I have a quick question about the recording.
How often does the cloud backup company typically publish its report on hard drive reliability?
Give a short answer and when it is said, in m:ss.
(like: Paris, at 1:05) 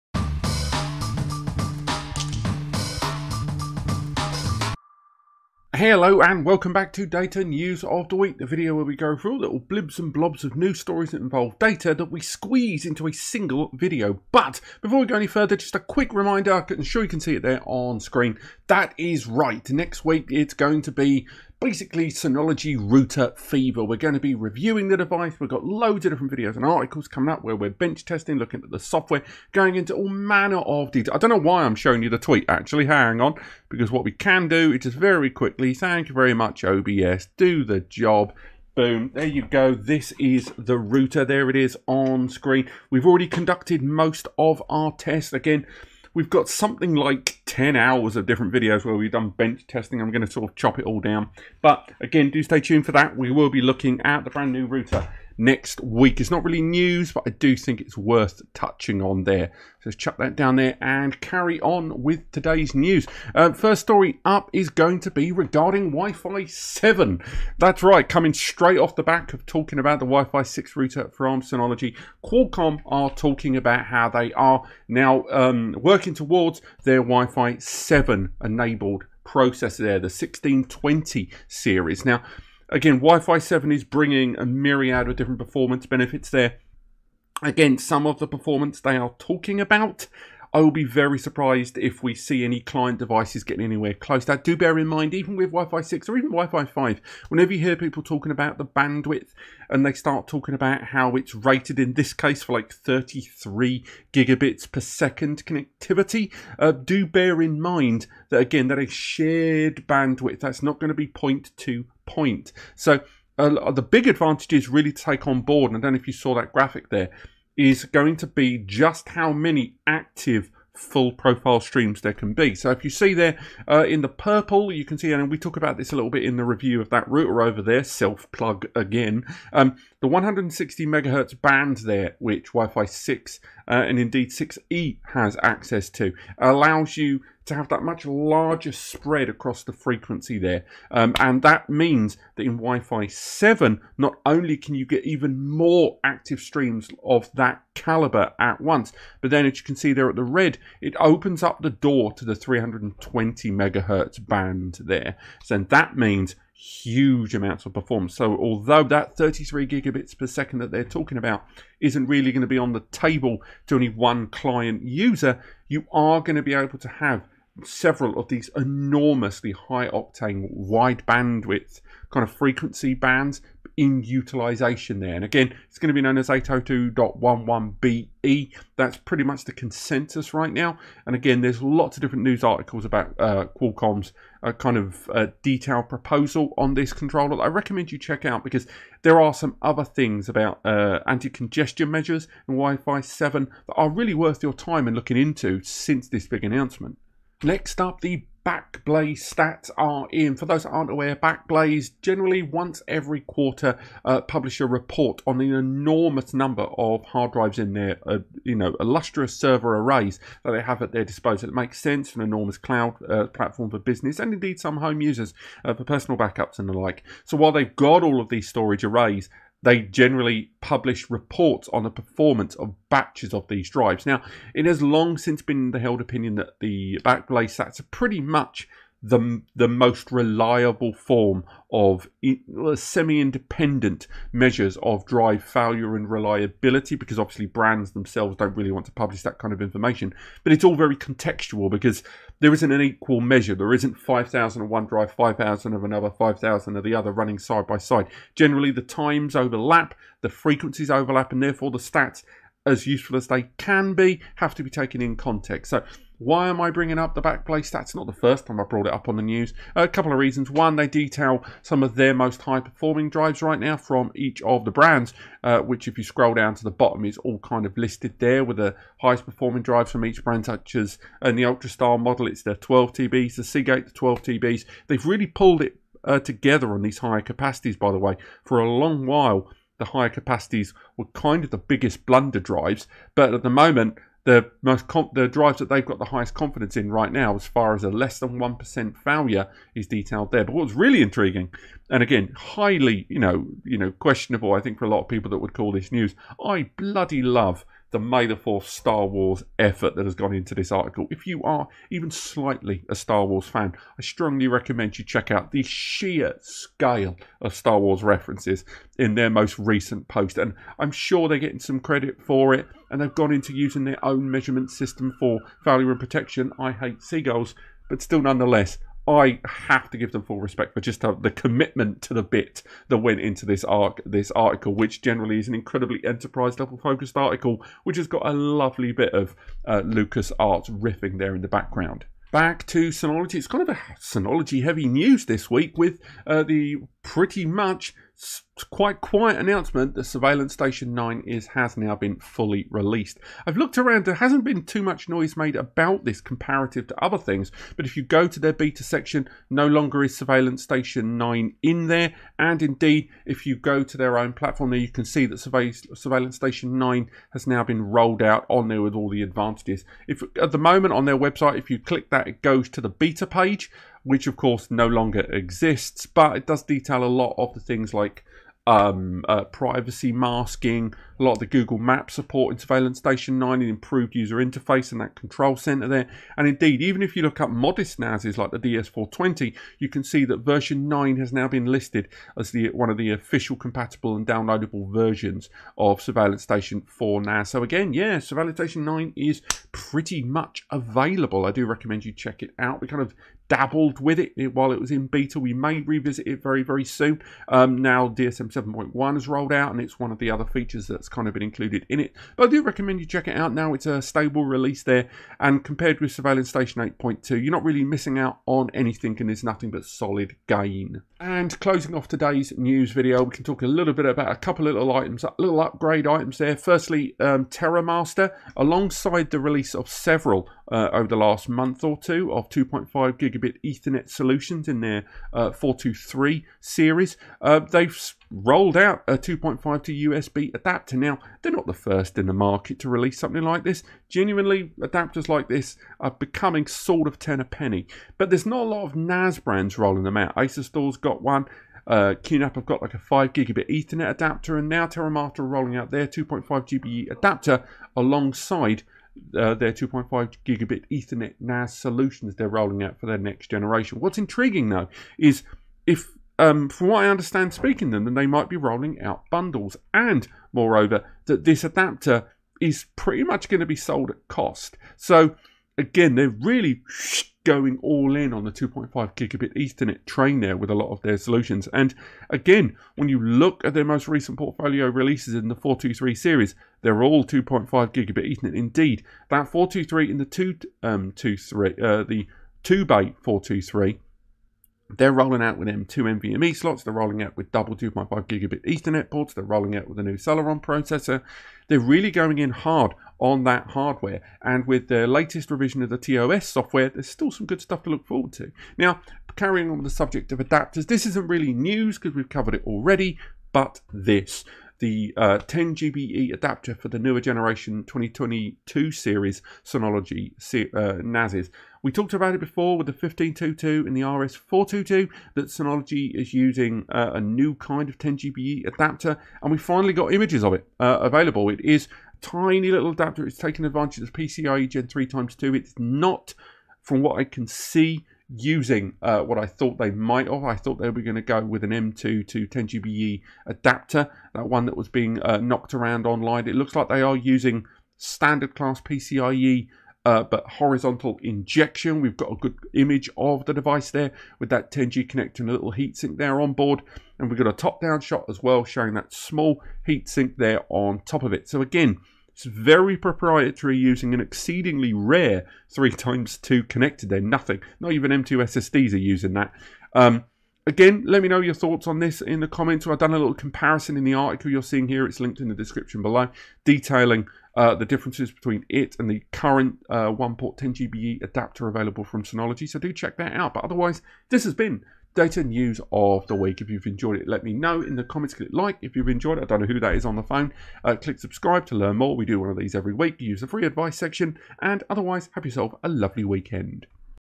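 once every quarter, at 3:22.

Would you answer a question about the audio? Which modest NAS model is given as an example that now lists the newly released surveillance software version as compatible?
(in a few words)
DS420.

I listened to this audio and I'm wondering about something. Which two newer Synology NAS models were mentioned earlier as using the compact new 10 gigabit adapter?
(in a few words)
1522 and RS422.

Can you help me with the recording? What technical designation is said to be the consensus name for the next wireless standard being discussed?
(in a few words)
802.11be.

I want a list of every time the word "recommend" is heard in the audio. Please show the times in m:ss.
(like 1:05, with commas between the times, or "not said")
3:07, 5:04, 6:31, 6:42.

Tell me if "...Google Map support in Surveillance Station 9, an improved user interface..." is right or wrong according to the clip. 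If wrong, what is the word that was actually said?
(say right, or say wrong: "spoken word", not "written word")
right.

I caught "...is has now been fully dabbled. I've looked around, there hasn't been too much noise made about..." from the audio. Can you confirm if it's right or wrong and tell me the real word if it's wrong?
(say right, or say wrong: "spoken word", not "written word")
wrong: "released", not "dabbled".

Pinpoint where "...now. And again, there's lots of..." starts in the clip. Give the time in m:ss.
3:00.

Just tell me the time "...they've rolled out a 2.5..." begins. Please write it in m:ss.
7:07.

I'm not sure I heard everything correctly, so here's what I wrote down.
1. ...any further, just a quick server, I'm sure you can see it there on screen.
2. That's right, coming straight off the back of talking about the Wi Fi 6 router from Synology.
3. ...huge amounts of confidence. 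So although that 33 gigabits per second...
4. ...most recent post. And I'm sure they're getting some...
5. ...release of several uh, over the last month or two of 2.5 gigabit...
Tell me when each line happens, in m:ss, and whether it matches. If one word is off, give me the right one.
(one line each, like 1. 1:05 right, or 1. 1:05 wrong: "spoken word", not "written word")
1. 0:15 wrong: "reminder", not "server"
2. 1:07 right
3. 2:36 wrong: "performance", not "confidence"
4. 5:09 right
5. 6:59 right.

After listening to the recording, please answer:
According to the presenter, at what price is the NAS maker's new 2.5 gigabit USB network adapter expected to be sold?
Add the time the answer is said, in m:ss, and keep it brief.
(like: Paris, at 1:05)
at cost, at 7:43.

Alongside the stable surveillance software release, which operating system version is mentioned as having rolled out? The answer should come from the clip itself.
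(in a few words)
DSM 7.1.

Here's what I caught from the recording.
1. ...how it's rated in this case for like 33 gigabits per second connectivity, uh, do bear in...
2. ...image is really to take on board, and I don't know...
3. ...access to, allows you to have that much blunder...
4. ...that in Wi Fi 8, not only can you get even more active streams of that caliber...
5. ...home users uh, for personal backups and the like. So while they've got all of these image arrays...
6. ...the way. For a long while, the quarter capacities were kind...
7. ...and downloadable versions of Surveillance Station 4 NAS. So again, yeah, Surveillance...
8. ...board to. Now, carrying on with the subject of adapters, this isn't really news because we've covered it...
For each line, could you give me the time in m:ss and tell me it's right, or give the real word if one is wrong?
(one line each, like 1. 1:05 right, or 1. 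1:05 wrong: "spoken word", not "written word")
1. 1:40 right
2. 1:54 wrong: "advantage", not "image"
3. 2:15 wrong: "larger", not "blunder"
4. 2:22 wrong: "7", not "8"
5. 3:34 wrong: "storage", not "image"
6. 4:37 wrong: "higher", not "quarter"
7. 6:24 right
8. 8:18 wrong: "forward", not "board".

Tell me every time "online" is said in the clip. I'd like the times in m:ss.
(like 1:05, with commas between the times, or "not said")
8:56.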